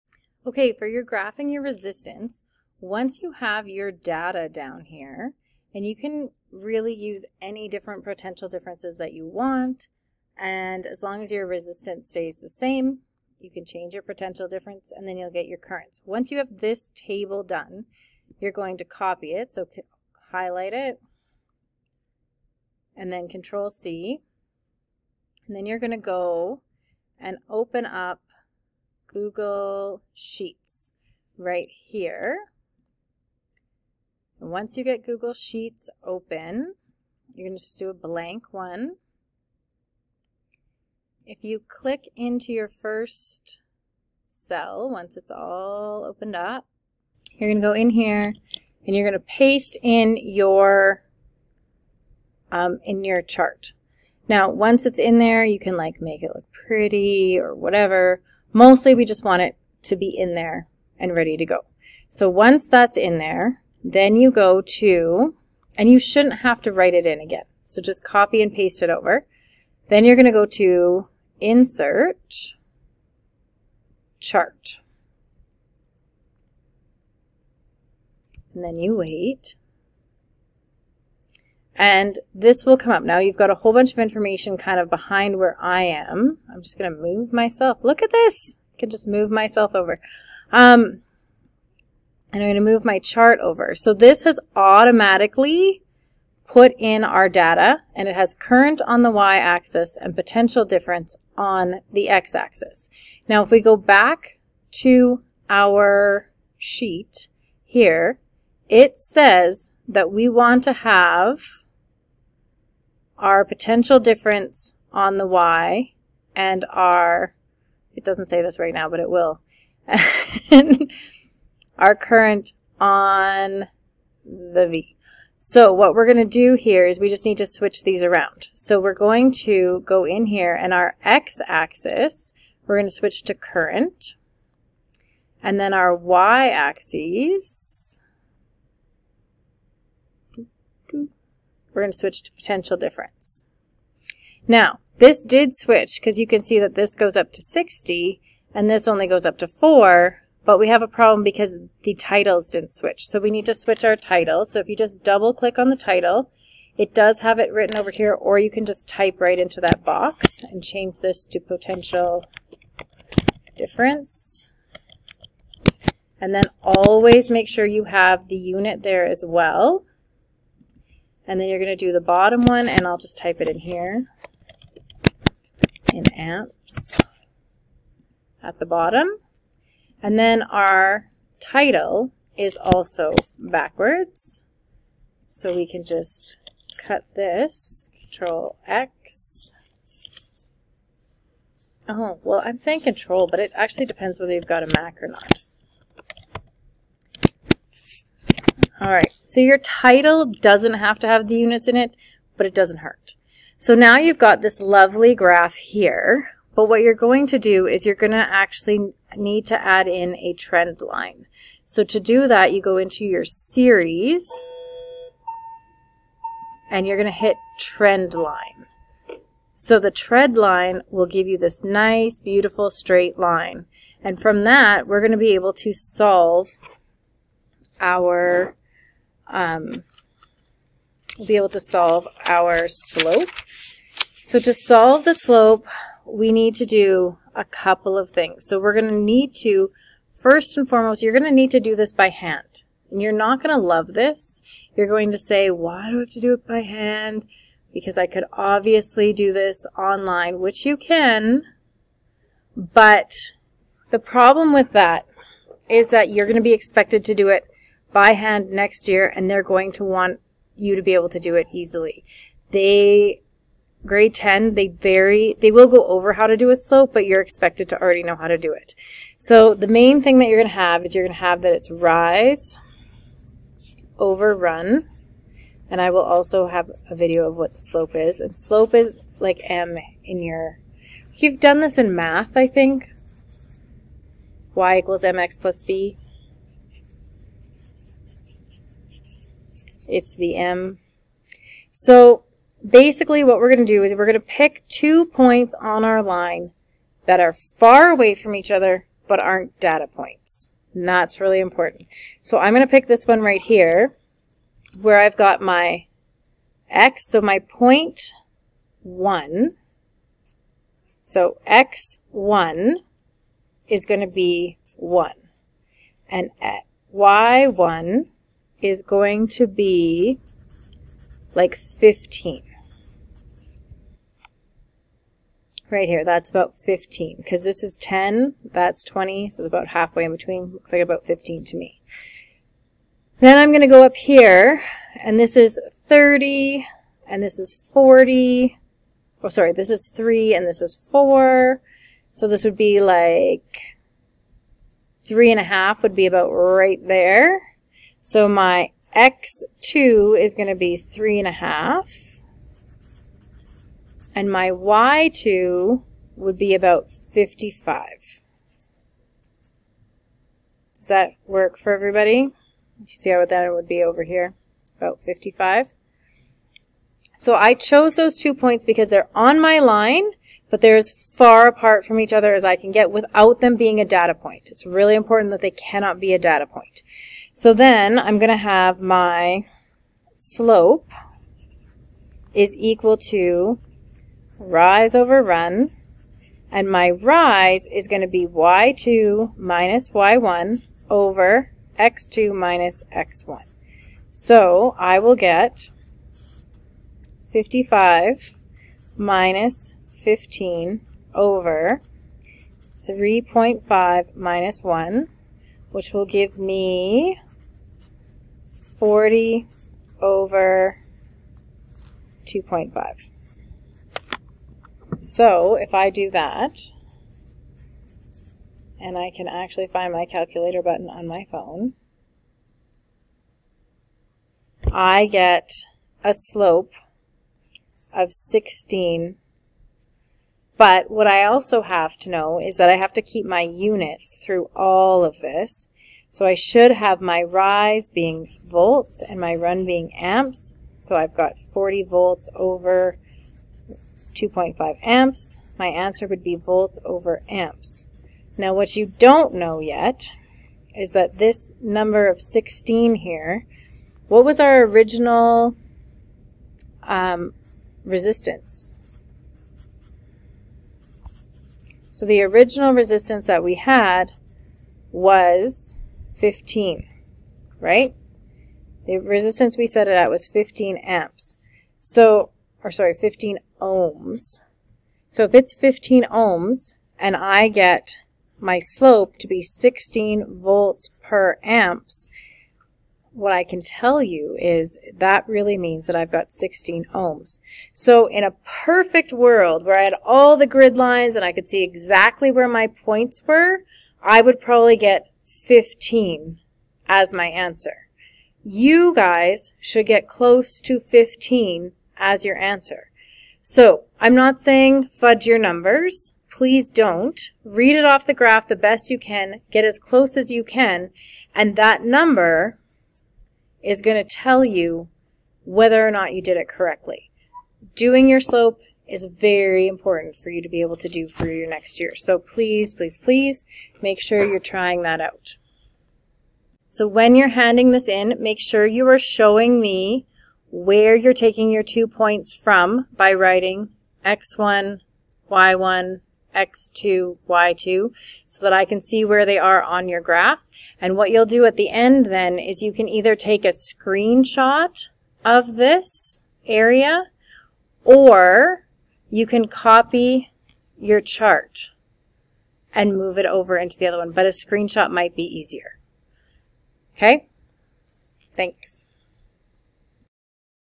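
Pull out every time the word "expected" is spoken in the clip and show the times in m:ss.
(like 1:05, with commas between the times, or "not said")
4:16, 4:27.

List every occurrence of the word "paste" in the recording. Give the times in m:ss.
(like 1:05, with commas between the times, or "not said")
0:49, 1:08.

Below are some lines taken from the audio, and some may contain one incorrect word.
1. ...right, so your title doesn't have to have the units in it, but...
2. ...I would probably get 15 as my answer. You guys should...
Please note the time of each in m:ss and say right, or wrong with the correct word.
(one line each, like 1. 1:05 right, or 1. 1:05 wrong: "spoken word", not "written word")
1. 3:18 right
2. 8:14 right.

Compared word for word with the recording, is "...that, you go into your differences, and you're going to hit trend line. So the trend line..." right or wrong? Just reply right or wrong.
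wrong.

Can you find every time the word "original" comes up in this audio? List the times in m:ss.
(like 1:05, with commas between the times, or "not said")
7:34, 7:42.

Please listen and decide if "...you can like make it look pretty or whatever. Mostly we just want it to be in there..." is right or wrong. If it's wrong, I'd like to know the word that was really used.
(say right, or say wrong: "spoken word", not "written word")
right.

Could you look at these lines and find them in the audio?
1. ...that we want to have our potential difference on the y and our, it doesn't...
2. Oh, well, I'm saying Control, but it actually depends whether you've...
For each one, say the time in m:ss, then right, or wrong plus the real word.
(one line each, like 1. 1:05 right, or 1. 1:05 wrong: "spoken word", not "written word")
1. 1:49 right
2. 3:11 right.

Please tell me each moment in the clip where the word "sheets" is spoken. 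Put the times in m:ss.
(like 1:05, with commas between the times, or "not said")
0:30, 0:35, 1:46.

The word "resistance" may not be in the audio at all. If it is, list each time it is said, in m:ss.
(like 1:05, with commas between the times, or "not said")
0:01, 0:11, 7:37, 7:42, 7:48.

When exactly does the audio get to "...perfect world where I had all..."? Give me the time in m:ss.
8:08.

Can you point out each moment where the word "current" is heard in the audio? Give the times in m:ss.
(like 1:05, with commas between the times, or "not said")
0:15, 1:38, 2:01, 2:13.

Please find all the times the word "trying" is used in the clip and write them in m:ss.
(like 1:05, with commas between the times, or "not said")
8:44.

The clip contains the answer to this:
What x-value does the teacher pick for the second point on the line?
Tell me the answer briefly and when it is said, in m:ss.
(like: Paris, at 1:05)
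3.5, at 5:50.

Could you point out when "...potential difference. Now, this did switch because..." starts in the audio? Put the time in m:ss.
2:22.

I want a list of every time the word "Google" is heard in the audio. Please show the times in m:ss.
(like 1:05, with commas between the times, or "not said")
0:29, 0:35.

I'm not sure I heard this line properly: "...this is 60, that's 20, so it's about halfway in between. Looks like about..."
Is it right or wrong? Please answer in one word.
wrong.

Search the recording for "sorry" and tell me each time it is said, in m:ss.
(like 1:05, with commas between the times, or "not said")
5:39, 7:52.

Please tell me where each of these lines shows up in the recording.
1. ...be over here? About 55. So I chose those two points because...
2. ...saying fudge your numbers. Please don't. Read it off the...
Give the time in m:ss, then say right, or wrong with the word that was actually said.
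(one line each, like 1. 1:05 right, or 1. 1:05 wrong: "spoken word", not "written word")
1. 6:03 right
2. 8:24 right.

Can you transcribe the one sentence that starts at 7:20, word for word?
So I've got 40 volts over 2.5 amps.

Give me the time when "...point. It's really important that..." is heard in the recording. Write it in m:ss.
6:14.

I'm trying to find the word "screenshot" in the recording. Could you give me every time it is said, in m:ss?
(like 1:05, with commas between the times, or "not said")
9:03, 9:14.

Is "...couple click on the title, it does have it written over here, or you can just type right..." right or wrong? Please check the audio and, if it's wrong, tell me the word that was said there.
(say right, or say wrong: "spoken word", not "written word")
wrong: "double", not "couple".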